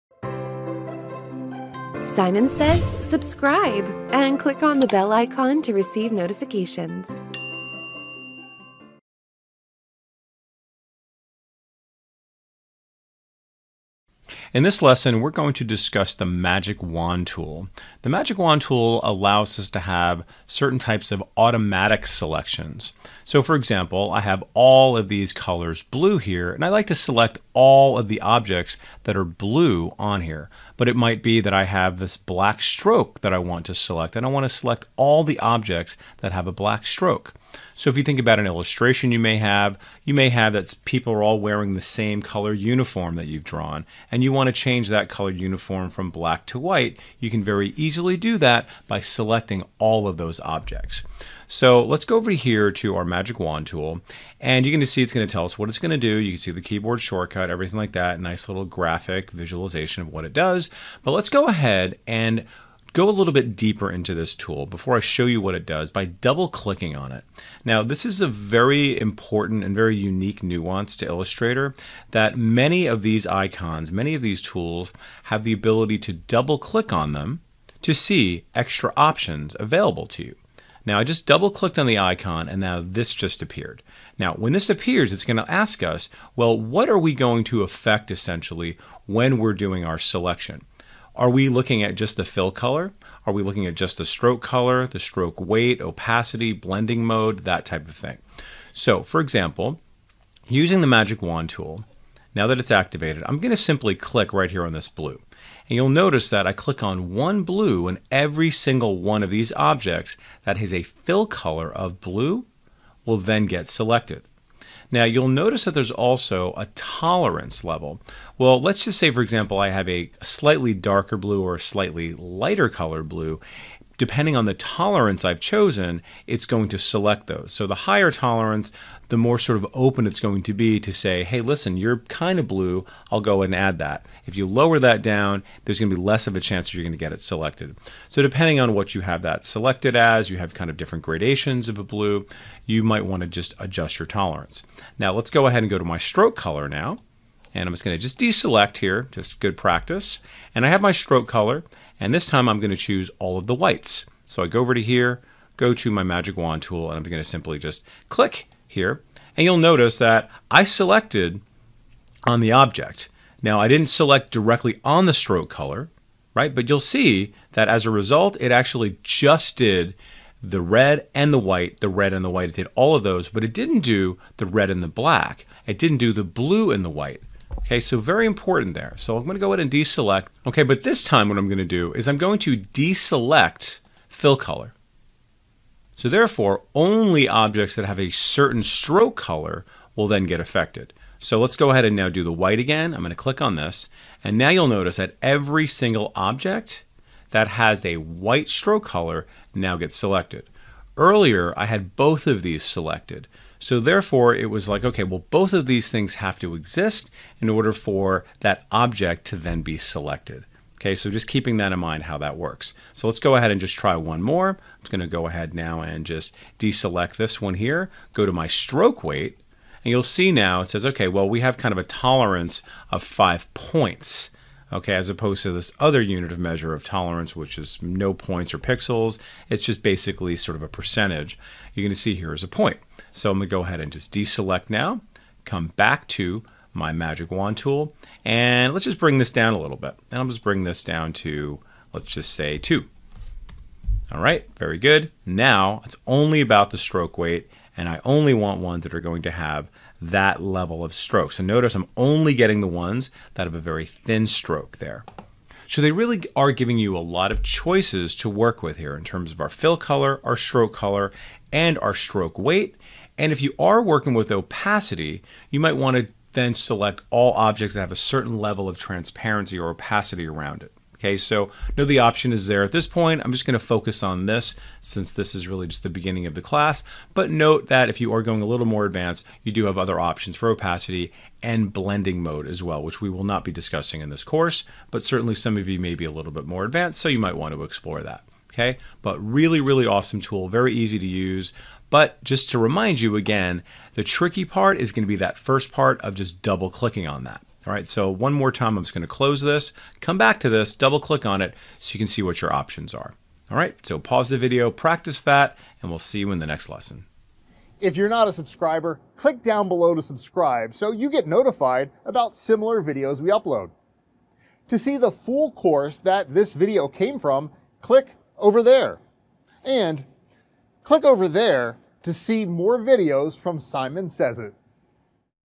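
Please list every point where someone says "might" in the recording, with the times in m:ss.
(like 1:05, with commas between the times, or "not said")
0:30, 2:22, 4:25, 4:47.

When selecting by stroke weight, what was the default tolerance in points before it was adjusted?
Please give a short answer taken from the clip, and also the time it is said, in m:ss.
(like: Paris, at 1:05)
5 points, at 3:43.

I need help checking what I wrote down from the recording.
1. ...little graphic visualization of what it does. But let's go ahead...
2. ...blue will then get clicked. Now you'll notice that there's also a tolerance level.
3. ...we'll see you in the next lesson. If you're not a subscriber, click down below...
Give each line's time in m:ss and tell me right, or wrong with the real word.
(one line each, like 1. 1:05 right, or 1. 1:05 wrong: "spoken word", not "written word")
1. 0:58 right
2. 1:51 wrong: "selected", not "clicked"
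3. 5:05 right.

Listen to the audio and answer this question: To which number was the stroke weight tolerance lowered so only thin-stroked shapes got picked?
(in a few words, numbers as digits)
2.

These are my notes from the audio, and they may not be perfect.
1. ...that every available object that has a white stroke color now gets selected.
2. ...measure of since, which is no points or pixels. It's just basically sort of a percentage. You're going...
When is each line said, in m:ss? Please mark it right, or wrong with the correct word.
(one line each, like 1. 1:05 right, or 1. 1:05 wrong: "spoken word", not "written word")
1. 3:14 wrong: "single", not "available"
2. 3:46 wrong: "tolerance", not "since".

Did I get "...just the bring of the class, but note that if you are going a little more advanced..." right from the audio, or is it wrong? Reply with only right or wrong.
wrong.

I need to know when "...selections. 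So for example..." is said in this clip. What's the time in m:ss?
0:22.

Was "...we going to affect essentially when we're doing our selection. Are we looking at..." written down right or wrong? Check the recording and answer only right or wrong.
right.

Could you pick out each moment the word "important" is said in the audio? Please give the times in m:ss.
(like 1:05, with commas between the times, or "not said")
1:08, 2:58.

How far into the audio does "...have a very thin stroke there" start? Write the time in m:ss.
4:13.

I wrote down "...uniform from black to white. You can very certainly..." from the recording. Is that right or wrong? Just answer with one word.
wrong.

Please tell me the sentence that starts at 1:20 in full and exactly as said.
Now I just double clicked on the icon and now this just appeared.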